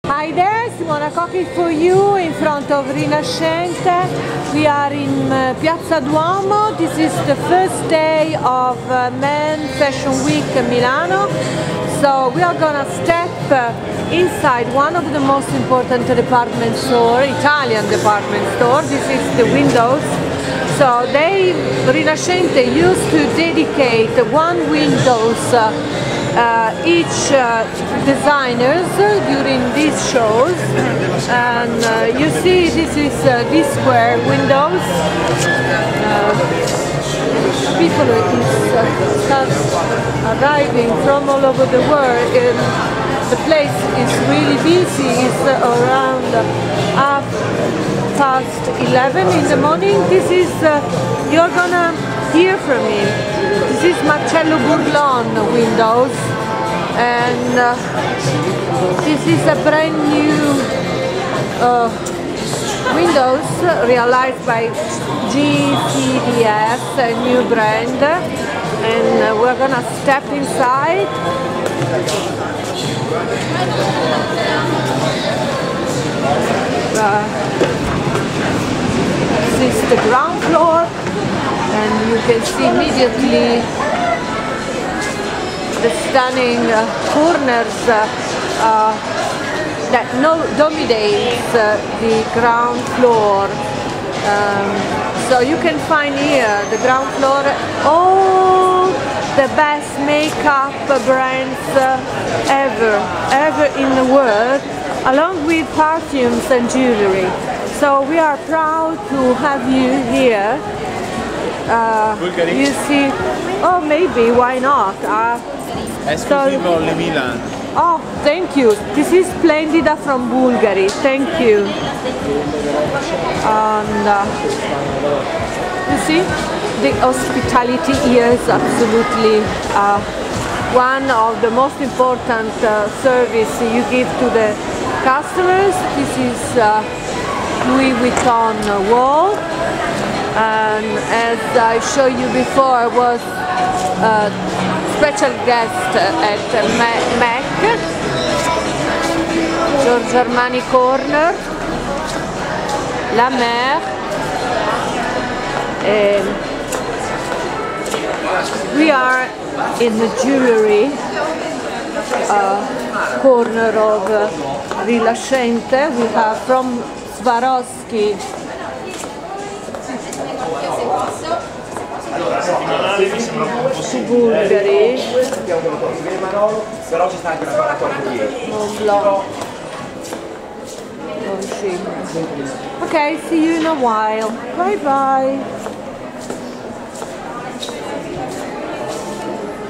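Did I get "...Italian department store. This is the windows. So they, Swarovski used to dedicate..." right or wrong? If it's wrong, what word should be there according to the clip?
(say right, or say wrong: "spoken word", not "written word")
wrong: "Rinascente", not "Swarovski".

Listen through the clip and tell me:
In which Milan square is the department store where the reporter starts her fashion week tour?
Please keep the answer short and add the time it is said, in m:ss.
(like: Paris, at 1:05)
Piazza Duomo, at 0:05.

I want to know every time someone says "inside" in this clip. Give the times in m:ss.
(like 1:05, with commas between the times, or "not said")
0:14, 1:10.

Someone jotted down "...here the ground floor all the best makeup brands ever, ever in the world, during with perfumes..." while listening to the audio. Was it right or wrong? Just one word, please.
wrong.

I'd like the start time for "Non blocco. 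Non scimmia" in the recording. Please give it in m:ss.
2:58.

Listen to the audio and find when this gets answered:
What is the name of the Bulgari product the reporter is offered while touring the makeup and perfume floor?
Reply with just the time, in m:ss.
1:59.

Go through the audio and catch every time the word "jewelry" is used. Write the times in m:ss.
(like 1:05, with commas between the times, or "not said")
1:46, 2:40.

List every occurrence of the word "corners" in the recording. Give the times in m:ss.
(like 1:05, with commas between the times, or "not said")
1:27, 2:30, 2:43.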